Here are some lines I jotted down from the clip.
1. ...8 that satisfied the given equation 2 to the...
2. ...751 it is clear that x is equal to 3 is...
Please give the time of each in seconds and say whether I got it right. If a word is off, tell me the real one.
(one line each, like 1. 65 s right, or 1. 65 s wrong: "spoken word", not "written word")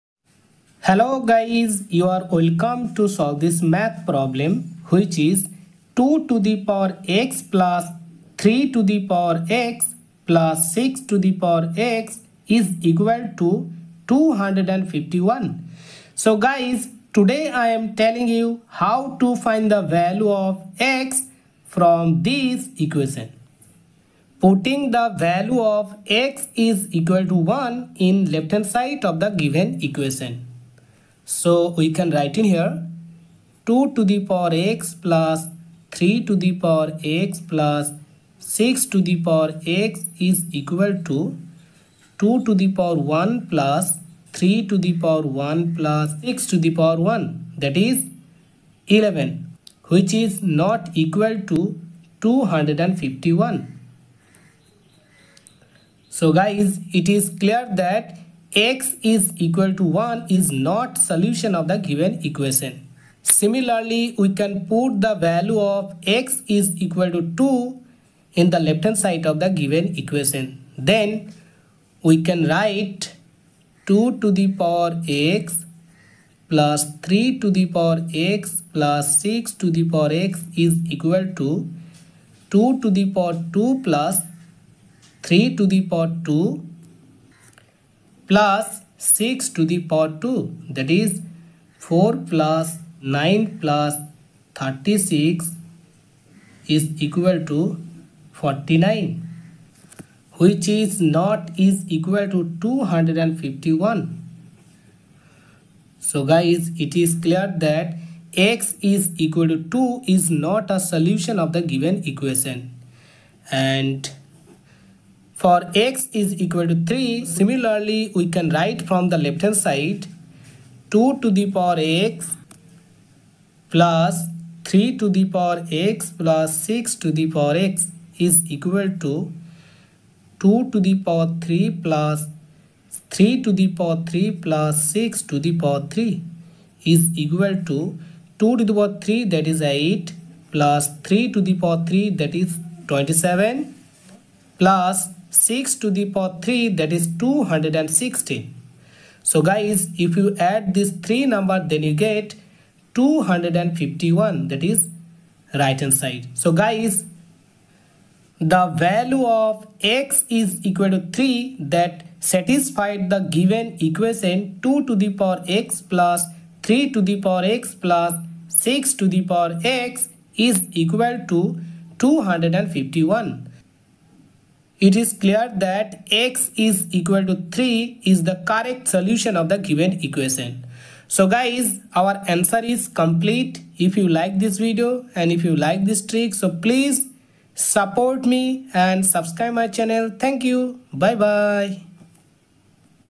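1. 161 s wrong: "3", not "8"
2. 171 s wrong: "251", not "751".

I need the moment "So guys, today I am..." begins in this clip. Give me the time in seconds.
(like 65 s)
16 s.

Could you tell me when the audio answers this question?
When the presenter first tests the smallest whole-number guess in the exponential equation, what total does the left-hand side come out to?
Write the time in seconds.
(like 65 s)
48 s.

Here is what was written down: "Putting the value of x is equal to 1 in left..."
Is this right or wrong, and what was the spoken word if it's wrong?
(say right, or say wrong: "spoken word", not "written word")
right.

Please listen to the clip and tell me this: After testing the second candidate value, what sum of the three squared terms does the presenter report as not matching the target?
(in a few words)
49.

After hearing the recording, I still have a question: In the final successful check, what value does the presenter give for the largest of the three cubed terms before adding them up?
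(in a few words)
216.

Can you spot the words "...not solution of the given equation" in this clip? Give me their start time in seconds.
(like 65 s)
60 s.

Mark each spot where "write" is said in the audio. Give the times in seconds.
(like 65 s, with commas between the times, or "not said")
32 s, 72 s, 118 s.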